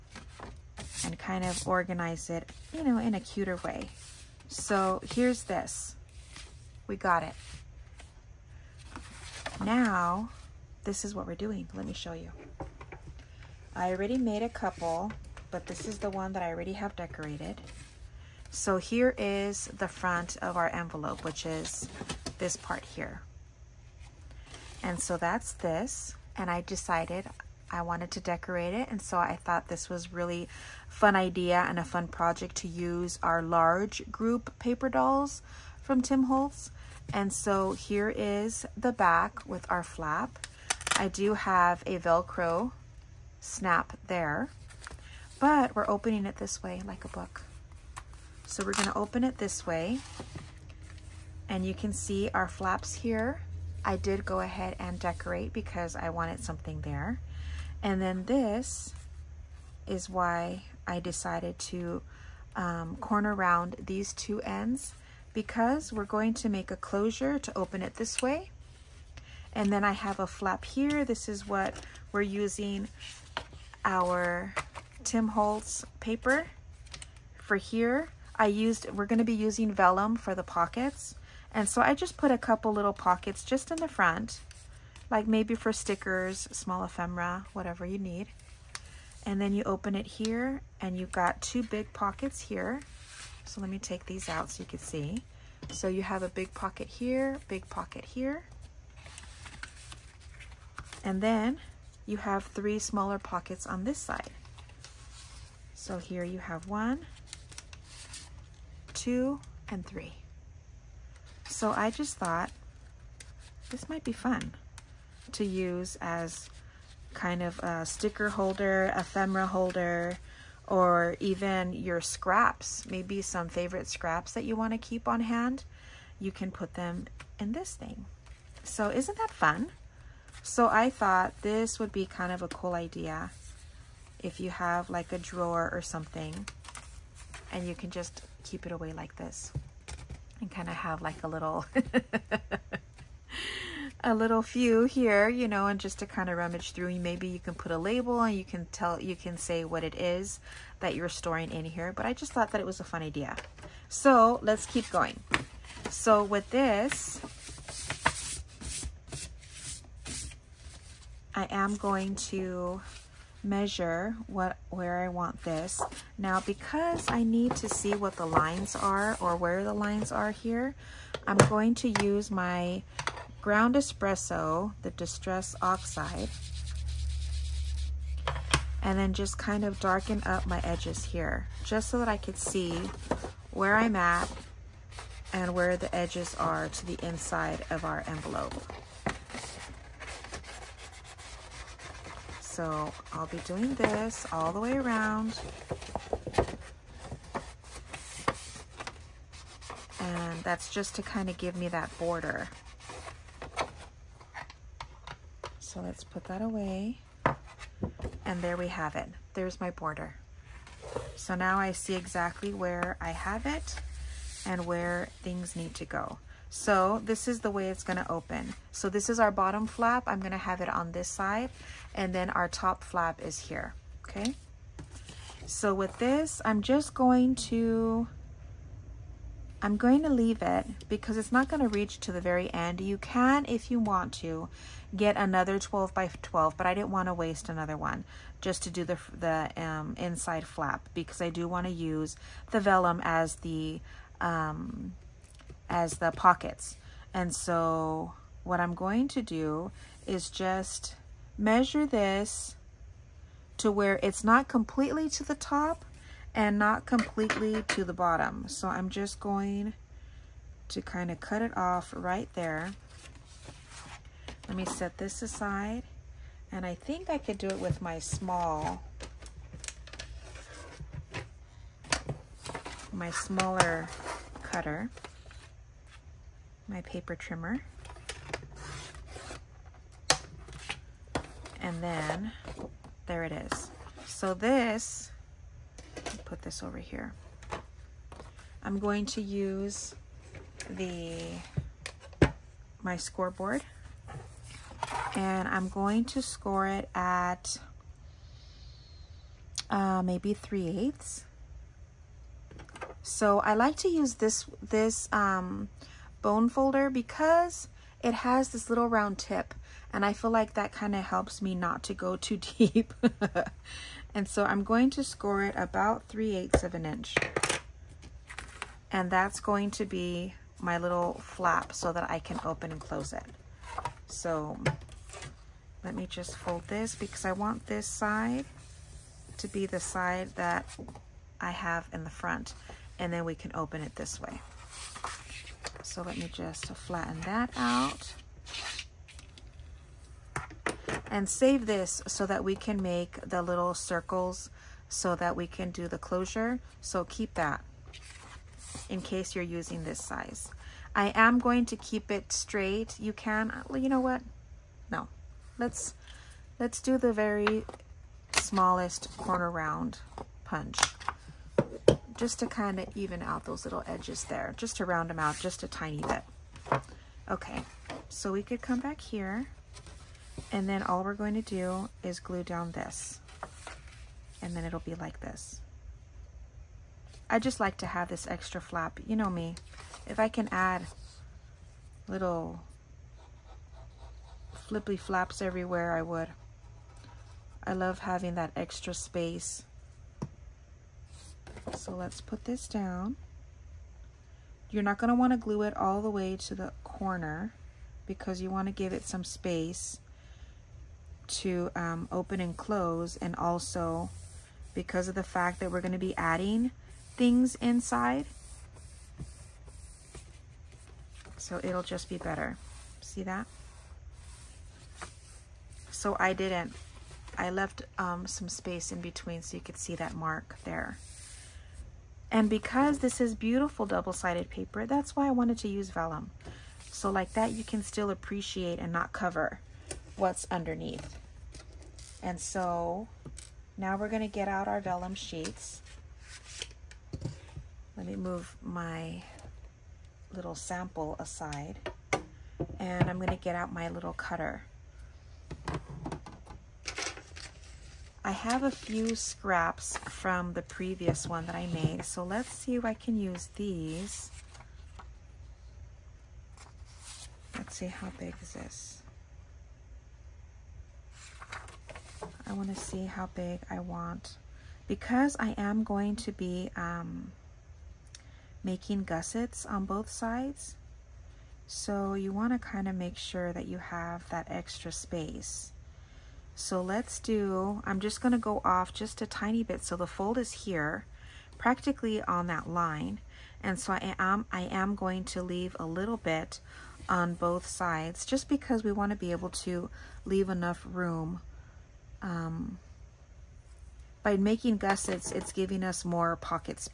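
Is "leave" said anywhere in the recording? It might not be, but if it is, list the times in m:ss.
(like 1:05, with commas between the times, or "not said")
3:50, 8:05, 8:10.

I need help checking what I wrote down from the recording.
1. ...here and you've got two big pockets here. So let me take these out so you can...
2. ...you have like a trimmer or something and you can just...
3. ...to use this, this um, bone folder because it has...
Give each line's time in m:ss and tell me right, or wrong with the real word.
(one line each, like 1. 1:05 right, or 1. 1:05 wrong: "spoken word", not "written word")
1. 1:30 right
2. 2:14 wrong: "drawer", not "trimmer"
3. 5:03 right.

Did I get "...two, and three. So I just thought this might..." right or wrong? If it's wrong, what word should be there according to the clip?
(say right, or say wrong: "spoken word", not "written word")
right.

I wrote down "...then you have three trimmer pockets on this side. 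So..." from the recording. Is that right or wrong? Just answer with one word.
wrong.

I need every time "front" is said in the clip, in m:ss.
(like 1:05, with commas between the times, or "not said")
0:19, 1:23, 5:32.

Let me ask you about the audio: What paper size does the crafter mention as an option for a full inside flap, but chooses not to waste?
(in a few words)
12 by 12.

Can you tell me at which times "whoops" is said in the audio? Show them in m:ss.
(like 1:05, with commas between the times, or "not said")
not said.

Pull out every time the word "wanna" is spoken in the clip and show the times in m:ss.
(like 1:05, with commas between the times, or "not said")
3:56, 4:01, 8:08.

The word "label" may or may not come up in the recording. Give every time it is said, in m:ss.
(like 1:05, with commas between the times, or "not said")
2:27.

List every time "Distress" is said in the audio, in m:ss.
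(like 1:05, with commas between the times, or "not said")
2:54.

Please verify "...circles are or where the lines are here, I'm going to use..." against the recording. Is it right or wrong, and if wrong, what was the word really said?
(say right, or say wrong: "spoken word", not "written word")
wrong: "lines", not "circles".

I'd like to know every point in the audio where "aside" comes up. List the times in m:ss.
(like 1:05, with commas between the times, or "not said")
4:25, 7:21.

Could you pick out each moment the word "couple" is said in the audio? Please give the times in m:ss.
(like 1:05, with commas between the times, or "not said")
0:14, 1:22.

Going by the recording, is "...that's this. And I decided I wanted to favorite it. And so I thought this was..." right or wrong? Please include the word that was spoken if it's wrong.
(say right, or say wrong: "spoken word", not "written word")
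wrong: "decorate", not "favorite".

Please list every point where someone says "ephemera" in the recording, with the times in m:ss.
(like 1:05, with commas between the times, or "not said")
1:26, 1:58.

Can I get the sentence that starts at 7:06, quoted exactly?
So like that, you can still appreciate and not cover what's underneath.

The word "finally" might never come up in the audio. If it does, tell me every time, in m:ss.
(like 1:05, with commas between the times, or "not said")
not said.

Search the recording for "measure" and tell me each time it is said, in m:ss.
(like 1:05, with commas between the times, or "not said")
2:43, 4:11.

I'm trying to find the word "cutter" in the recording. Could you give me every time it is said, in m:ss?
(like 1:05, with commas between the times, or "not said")
4:34, 7:24.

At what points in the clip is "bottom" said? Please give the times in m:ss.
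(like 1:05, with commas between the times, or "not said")
3:39, 4:17.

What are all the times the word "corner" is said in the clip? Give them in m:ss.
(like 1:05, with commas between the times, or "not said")
1:02, 5:59, 6:36.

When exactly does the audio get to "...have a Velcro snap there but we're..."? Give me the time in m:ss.
0:41.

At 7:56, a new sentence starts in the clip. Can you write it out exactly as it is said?
So let's do, I'm just gonna go off just a tiny bit.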